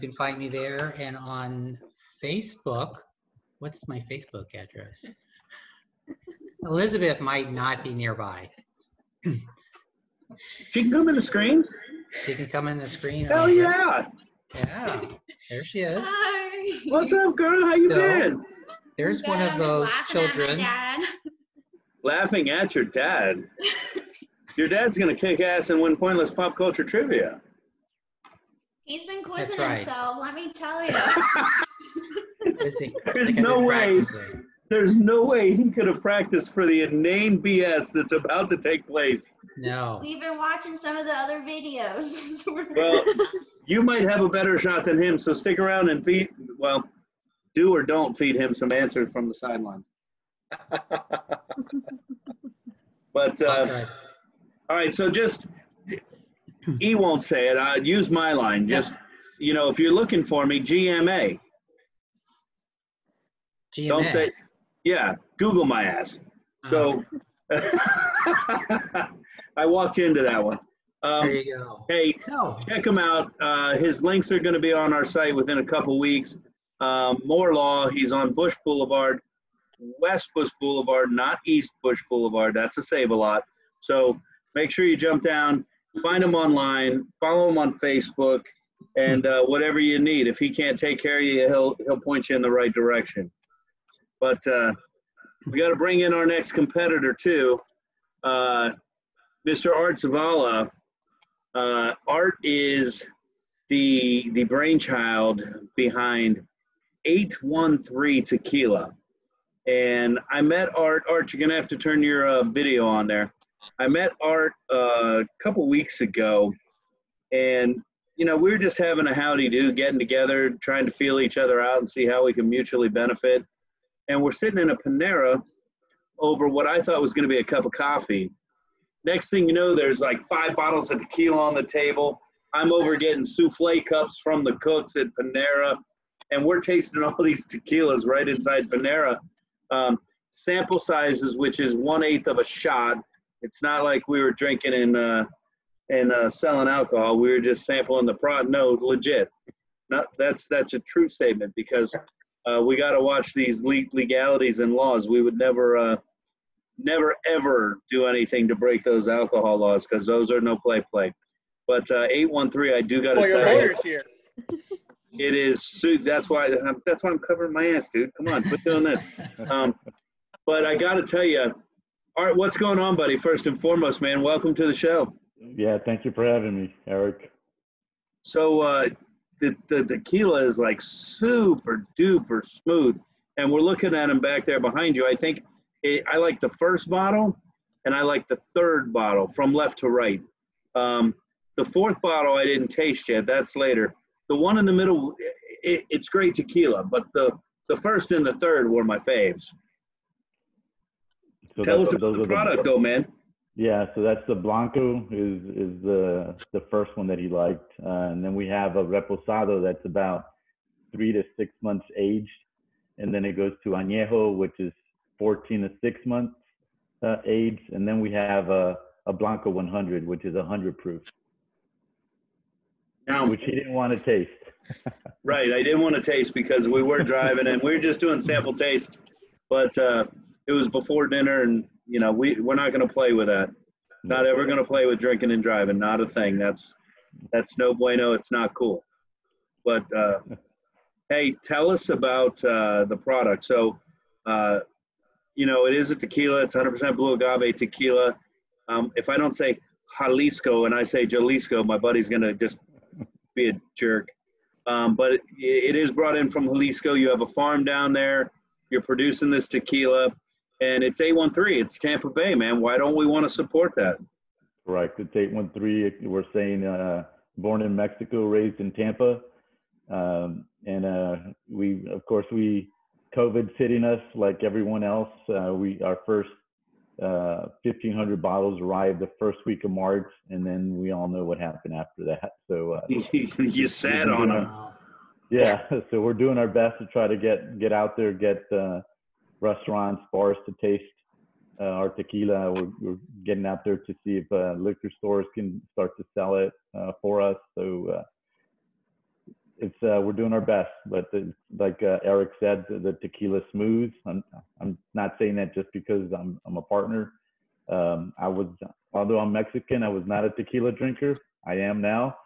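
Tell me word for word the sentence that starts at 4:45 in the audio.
Yeah, so we're doing our best to try to get get out there, get uh, restaurants, bars to taste uh, our tequila.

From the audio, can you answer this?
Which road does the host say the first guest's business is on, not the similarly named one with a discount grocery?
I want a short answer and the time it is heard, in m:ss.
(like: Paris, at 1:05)
West Bush Boulevard, at 1:19.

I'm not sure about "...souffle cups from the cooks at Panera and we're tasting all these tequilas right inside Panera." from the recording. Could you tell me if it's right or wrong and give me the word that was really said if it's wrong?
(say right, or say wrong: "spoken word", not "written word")
right.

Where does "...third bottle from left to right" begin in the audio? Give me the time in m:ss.
3:08.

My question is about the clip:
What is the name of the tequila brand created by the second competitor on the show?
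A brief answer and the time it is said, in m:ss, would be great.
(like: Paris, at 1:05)
813 Tequila, at 1:47.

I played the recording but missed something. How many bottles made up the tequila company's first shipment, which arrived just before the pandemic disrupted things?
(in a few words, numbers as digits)
1,500.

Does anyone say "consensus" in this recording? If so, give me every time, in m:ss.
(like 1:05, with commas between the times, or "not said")
not said.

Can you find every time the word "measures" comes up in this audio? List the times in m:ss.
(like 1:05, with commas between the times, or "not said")
not said.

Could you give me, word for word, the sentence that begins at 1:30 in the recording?
If he can't take care of you, he'll he'll point you in the right direction.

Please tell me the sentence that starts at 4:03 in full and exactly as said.
So, uh, you know, it is a tequila.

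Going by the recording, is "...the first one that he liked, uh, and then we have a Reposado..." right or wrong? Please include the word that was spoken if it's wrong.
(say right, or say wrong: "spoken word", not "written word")
right.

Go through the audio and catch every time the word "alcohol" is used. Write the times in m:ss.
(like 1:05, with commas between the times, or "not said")
2:26, 2:39.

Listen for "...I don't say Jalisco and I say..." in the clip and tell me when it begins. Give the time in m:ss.
4:09.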